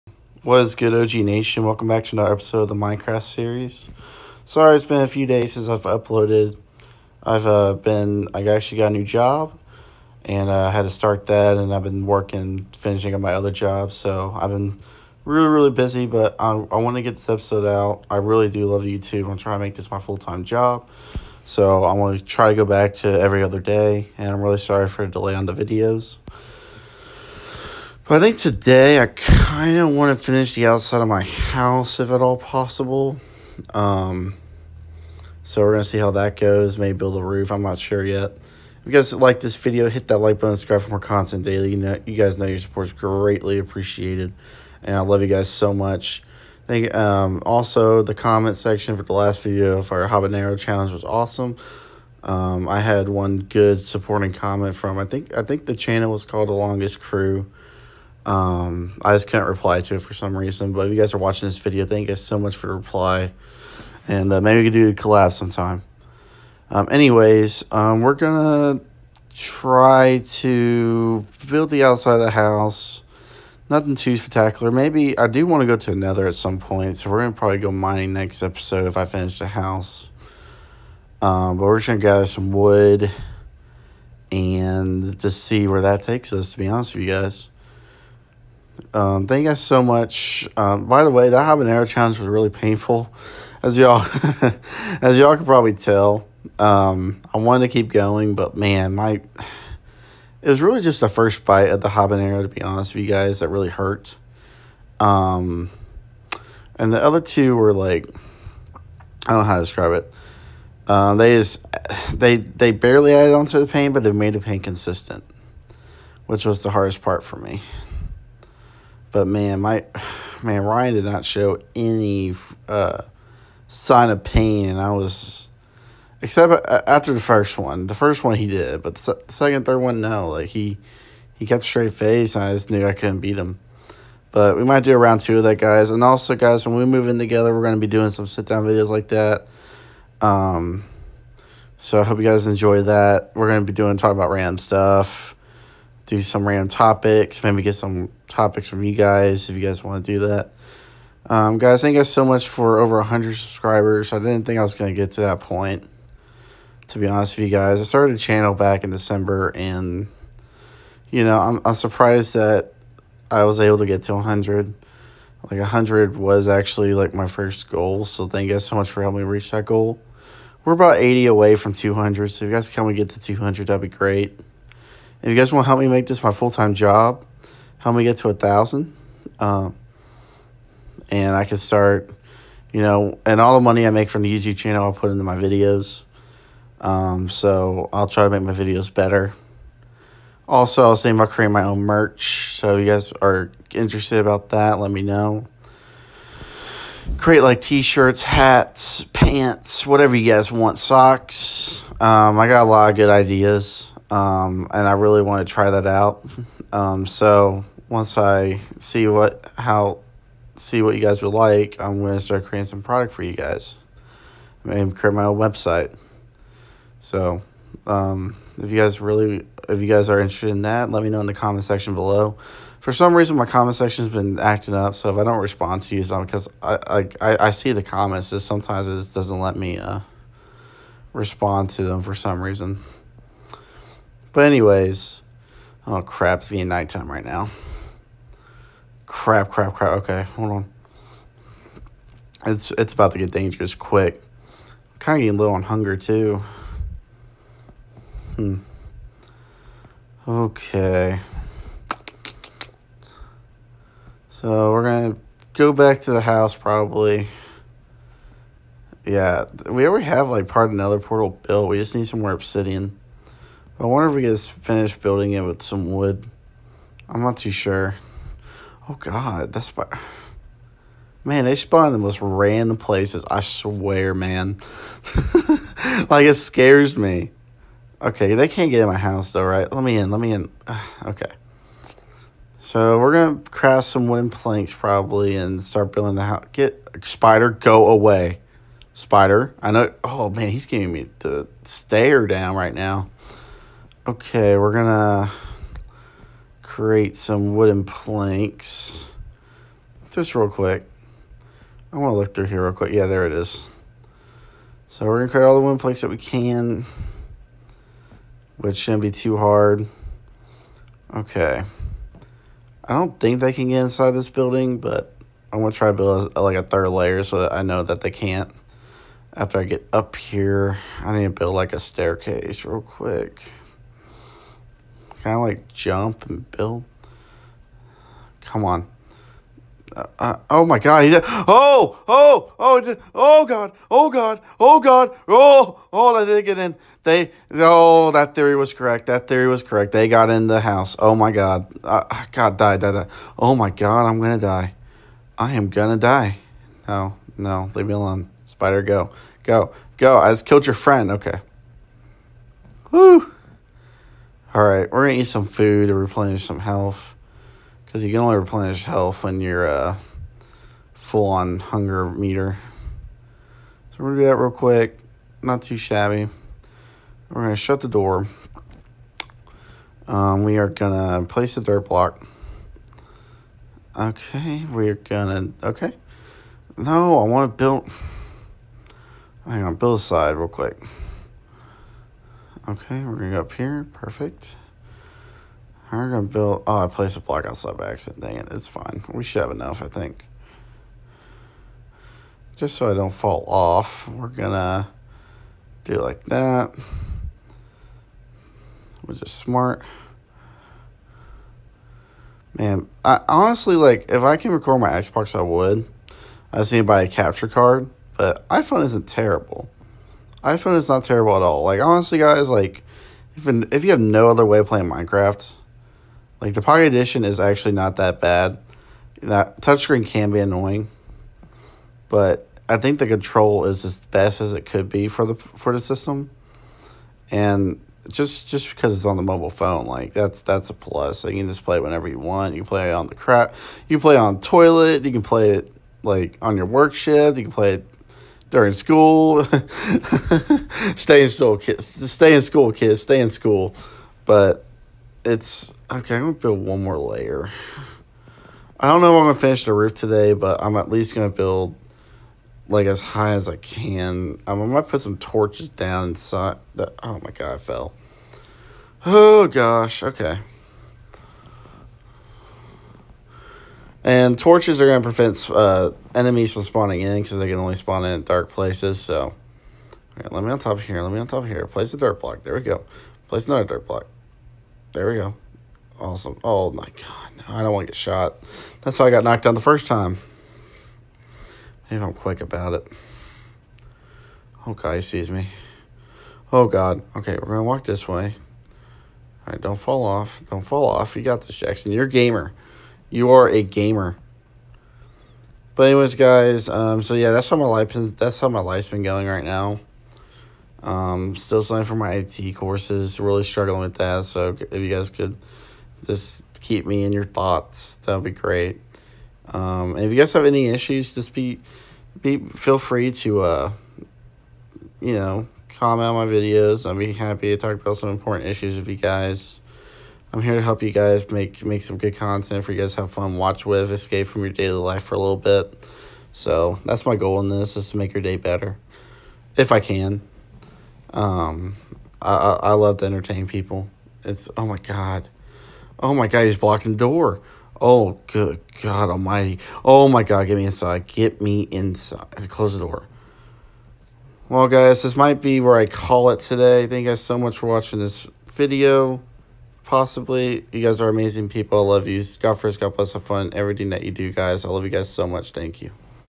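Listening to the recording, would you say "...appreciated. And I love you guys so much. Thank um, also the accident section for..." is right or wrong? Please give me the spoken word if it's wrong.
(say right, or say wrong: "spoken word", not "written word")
wrong: "comment", not "accident".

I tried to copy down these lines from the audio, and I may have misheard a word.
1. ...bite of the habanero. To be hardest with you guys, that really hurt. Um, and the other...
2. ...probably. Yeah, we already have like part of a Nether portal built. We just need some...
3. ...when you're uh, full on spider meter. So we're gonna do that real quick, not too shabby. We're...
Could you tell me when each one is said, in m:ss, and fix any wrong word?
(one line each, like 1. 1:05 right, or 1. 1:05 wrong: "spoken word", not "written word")
1. 1:41 wrong: "honest", not "hardest"
2. 4:16 right
3. 5:59 wrong: "hunger", not "spider".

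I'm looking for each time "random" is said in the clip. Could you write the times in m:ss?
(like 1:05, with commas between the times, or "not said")
2:26, 4:32.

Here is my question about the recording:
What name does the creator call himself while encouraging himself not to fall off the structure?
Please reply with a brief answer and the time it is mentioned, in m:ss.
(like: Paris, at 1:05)
Jackson, at 8:11.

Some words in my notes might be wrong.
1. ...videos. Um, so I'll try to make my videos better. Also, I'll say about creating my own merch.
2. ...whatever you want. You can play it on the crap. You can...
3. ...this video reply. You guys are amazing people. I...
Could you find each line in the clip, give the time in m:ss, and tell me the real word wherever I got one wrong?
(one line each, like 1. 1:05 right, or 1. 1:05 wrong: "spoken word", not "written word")
1. 3:05 right
2. 7:11 wrong: "whenever", not "whatever"
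3. 9:07 wrong: "possibly", not "reply".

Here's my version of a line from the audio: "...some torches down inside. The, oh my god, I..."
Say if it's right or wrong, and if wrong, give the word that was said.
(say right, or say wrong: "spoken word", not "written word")
right.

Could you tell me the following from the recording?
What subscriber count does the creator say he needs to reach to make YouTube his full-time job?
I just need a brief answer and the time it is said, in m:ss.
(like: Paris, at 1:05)
a thousand, at 2:58.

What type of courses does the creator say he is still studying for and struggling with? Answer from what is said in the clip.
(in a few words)
IT courses.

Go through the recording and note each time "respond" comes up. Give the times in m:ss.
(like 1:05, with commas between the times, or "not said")
3:45, 3:51.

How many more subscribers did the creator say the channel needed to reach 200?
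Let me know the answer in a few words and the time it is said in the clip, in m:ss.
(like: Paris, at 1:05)
80, at 2:50.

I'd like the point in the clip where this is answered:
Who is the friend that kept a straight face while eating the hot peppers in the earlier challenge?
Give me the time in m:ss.
2:00.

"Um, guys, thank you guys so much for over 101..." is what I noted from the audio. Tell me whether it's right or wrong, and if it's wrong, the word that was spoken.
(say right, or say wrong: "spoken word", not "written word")
wrong: "100", not "101".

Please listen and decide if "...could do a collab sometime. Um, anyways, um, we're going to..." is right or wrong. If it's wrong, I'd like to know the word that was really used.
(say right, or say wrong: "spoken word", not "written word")
right.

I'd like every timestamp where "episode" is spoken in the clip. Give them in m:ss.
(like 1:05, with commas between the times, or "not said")
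0:02, 0:17, 1:18.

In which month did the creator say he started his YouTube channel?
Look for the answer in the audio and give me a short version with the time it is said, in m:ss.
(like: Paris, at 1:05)
December, at 2:38.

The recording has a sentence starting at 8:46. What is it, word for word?
So that's my goal in this is to make your day better, if I can.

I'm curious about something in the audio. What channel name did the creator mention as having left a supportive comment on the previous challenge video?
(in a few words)
The Longest Crew.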